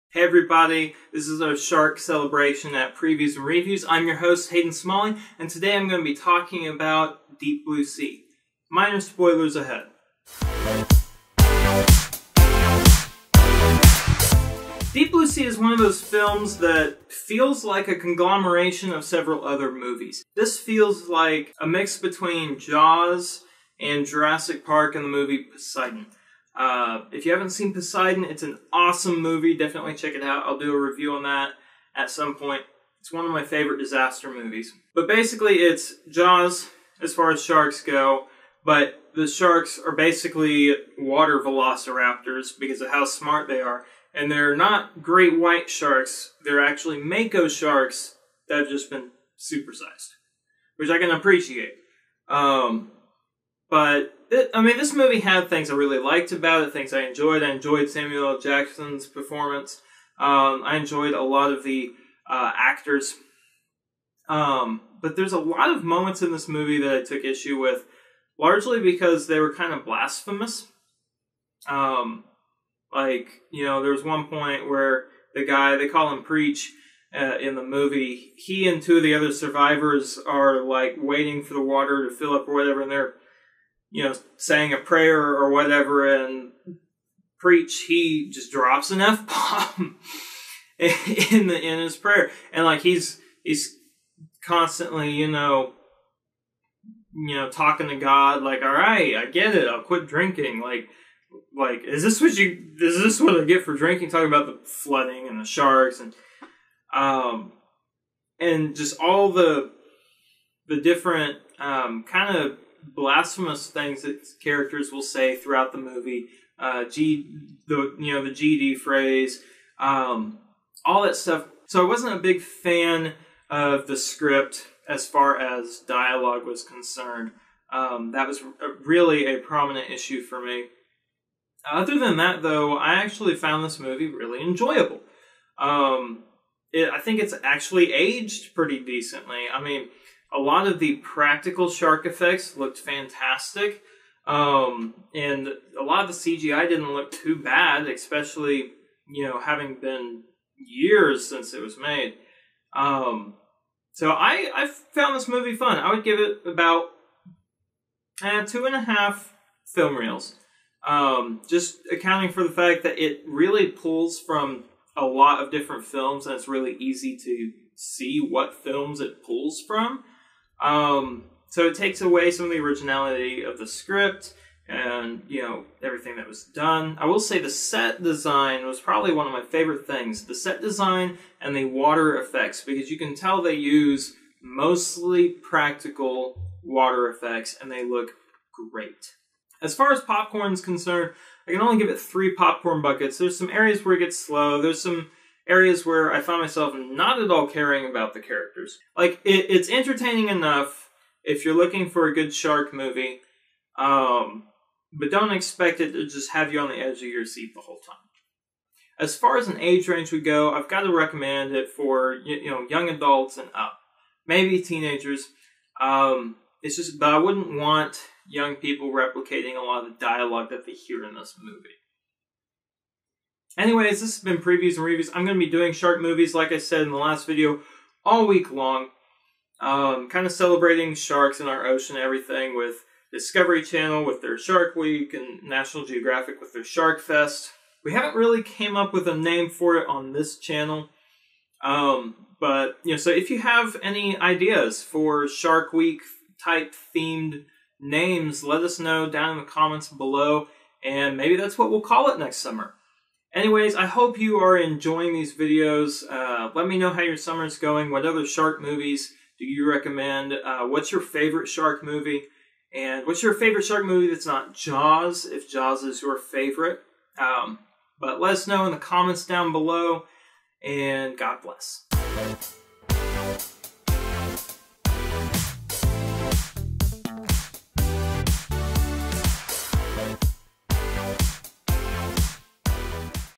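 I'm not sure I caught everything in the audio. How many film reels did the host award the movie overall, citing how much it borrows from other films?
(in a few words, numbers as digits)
2.5.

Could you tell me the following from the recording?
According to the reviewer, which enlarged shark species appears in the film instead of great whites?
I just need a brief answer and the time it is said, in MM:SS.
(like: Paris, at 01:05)
Mako sharks, at 00:47.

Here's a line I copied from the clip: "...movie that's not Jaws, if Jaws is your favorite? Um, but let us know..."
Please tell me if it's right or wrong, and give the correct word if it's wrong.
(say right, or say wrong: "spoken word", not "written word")
right.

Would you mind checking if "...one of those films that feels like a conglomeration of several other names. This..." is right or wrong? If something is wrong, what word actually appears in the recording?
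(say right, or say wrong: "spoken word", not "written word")
wrong: "movies", not "names".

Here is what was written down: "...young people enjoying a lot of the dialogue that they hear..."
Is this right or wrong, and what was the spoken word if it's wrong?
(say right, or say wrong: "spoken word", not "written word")
wrong: "replicating", not "enjoying".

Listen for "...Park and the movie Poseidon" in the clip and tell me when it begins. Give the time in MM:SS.
00:24.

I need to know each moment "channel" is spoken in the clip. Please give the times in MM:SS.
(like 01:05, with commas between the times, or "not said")
03:53, 04:00.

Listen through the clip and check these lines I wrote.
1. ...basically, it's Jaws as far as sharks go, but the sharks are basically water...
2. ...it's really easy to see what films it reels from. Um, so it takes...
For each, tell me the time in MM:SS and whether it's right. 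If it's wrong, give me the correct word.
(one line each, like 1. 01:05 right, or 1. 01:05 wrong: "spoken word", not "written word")
1. 00:35 right
2. 02:46 wrong: "pulls", not "reels".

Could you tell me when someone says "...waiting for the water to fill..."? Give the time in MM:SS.
01:20.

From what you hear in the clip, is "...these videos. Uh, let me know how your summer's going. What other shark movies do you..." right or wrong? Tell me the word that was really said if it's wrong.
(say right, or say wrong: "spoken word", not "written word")
right.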